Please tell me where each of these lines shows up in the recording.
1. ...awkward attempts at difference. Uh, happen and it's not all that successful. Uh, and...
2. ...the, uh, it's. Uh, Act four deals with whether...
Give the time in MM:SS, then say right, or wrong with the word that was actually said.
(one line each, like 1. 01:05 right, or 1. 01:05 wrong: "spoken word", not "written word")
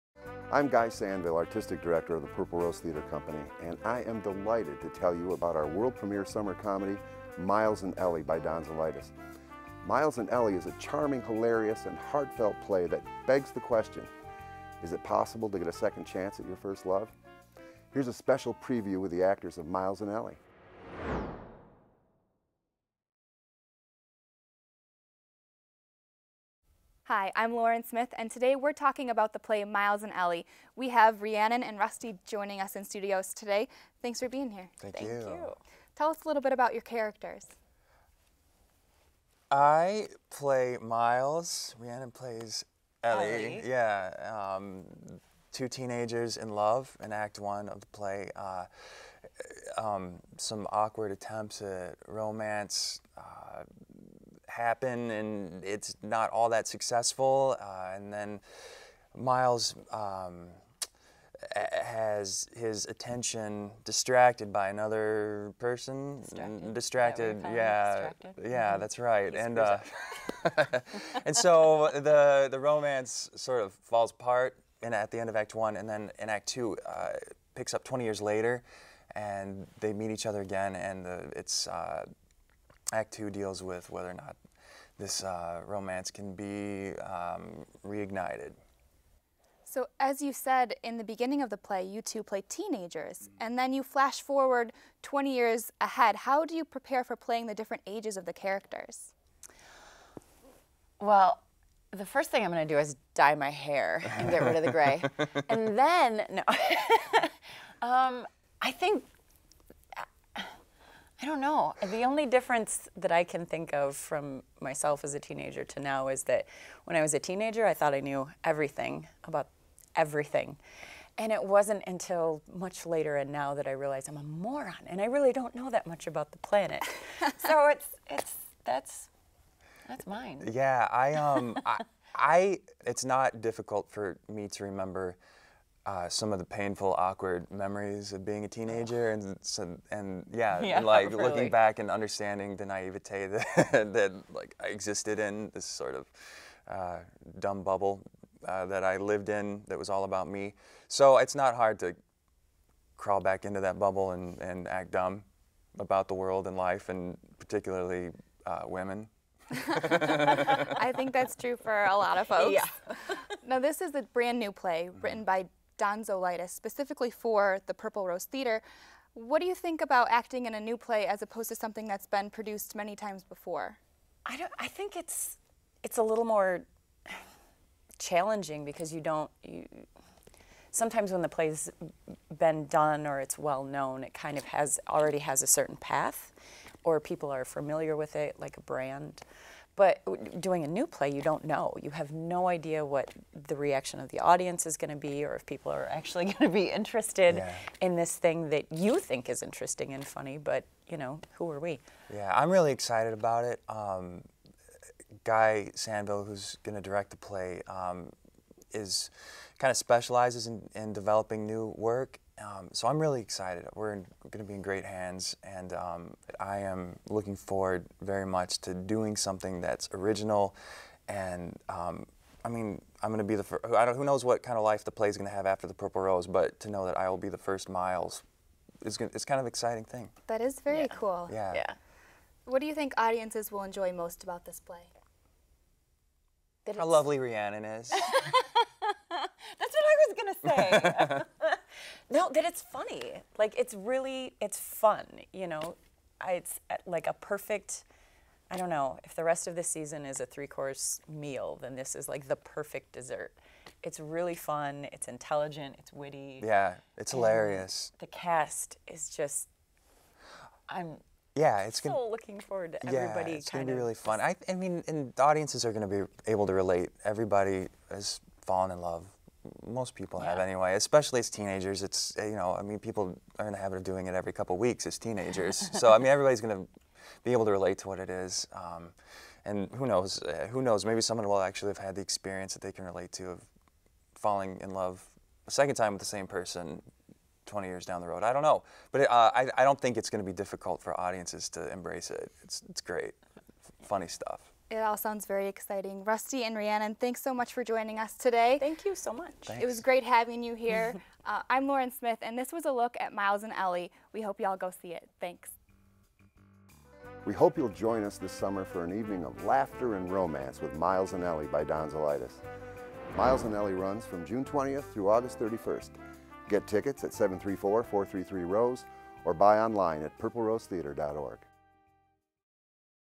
1. 00:50 wrong: "romance", not "difference"
2. 01:21 wrong: "two", not "four".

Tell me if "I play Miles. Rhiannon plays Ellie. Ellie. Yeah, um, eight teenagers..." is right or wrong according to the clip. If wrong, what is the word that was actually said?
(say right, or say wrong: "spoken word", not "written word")
wrong: "two", not "eight".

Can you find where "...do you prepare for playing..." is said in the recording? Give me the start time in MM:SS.
01:36.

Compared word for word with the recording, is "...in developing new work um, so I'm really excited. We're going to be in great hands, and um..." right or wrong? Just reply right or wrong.
right.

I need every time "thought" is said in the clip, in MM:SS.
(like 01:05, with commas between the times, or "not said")
01:57.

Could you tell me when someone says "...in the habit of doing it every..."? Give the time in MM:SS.
04:33.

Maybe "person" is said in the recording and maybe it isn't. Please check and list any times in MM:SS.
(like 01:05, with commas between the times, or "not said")
01:05, 04:46.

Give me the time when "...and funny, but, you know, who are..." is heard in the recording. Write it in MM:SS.
03:19.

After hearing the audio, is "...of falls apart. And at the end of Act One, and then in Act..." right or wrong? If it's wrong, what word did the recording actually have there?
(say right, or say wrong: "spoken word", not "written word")
right.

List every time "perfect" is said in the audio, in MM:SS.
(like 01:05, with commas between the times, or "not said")
04:07, 04:12.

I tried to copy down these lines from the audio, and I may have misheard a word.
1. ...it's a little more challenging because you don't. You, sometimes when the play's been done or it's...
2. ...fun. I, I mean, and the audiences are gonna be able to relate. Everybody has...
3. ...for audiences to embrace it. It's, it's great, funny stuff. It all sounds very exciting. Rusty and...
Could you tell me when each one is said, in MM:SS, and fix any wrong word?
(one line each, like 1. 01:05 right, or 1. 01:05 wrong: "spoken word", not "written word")
1. 02:55 right
2. 04:23 right
3. 04:50 right.